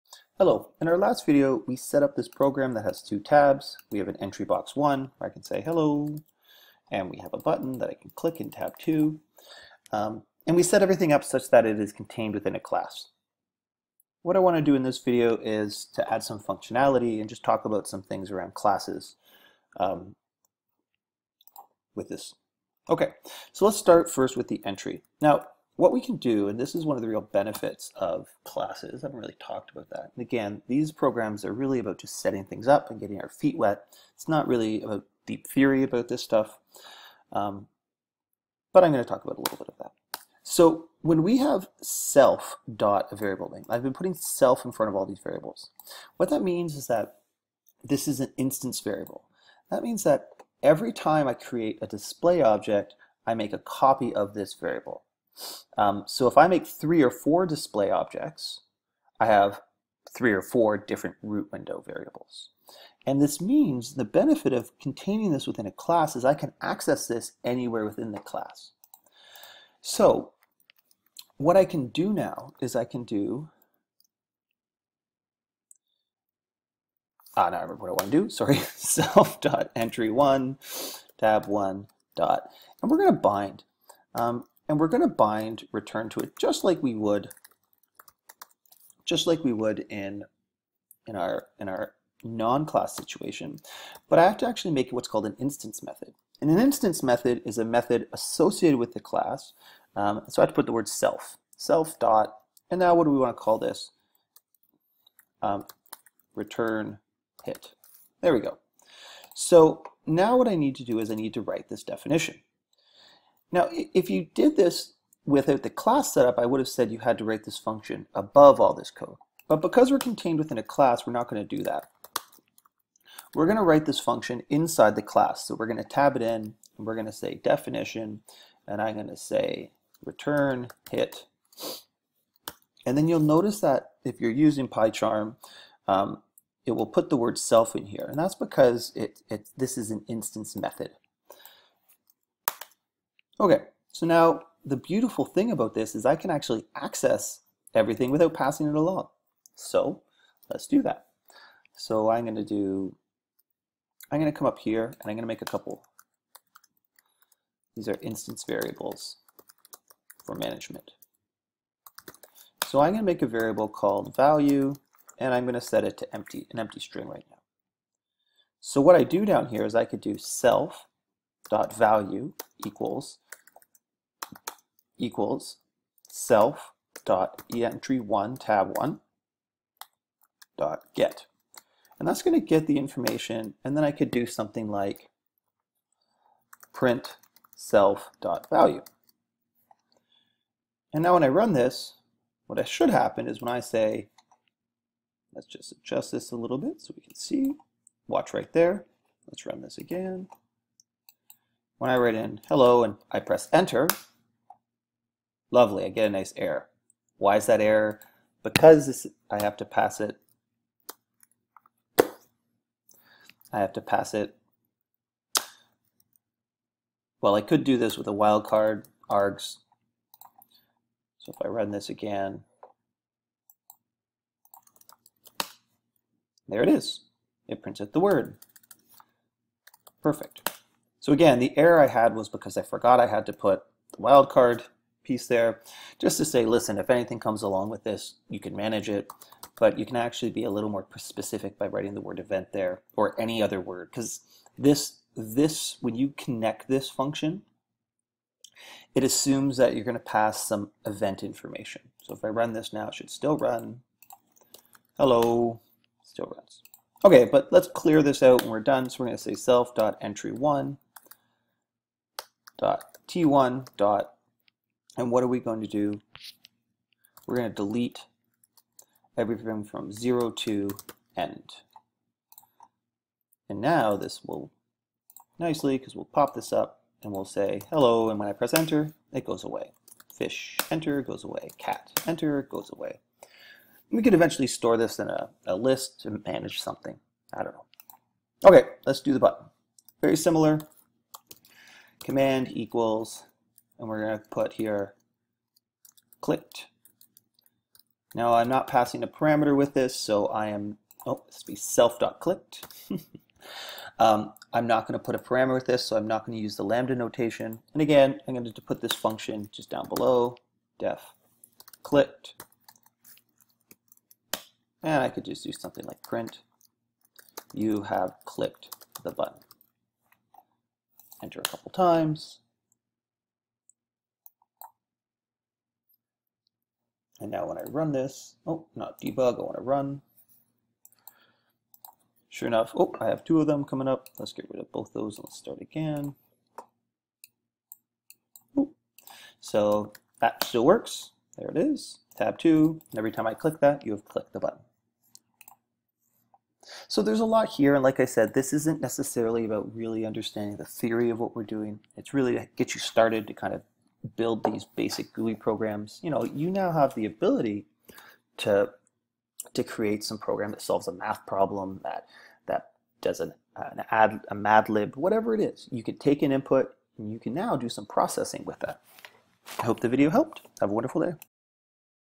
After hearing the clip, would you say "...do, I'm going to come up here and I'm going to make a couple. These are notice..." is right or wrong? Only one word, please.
wrong.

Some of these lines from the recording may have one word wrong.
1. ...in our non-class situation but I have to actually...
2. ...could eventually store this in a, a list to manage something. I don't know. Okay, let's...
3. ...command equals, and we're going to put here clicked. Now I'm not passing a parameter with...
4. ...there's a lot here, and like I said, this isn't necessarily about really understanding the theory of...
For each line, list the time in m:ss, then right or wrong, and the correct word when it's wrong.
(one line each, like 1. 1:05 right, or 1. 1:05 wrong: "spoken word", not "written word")
1. 1:31 right
2. 4:44 right
3. 4:52 right
4. 5:47 right.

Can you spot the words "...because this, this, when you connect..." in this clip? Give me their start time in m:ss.
4:03.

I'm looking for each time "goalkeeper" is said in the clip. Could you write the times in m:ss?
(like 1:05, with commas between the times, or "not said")
not said.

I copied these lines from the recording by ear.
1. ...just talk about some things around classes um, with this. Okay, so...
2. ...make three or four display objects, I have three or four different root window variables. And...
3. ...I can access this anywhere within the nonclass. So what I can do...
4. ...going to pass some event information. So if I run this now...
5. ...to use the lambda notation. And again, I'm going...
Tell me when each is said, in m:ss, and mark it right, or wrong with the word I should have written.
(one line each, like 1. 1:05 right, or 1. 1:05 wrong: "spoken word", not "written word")
1. 0:17 right
2. 0:56 right
3. 1:06 wrong: "class", not "nonclass"
4. 4:09 right
5. 5:06 right.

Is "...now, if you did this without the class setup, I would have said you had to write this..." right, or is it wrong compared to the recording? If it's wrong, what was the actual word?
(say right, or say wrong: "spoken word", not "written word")
right.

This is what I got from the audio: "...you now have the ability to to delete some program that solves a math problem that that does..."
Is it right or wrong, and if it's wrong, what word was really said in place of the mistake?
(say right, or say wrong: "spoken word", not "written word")
wrong: "create", not "delete".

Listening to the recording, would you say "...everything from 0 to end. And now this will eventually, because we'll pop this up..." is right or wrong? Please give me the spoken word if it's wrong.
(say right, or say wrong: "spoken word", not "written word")
wrong: "nicely", not "eventually".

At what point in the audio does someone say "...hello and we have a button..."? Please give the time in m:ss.
0:05.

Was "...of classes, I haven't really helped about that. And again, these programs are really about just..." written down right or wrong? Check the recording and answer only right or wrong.
wrong.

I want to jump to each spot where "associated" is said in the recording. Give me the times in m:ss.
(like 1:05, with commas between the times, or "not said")
1:38.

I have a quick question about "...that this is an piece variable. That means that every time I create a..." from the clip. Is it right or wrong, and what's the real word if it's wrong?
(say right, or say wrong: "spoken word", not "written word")
wrong: "instance", not "piece".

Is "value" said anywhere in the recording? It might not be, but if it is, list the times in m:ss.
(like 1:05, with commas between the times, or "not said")
2:44, 2:51, 3:08.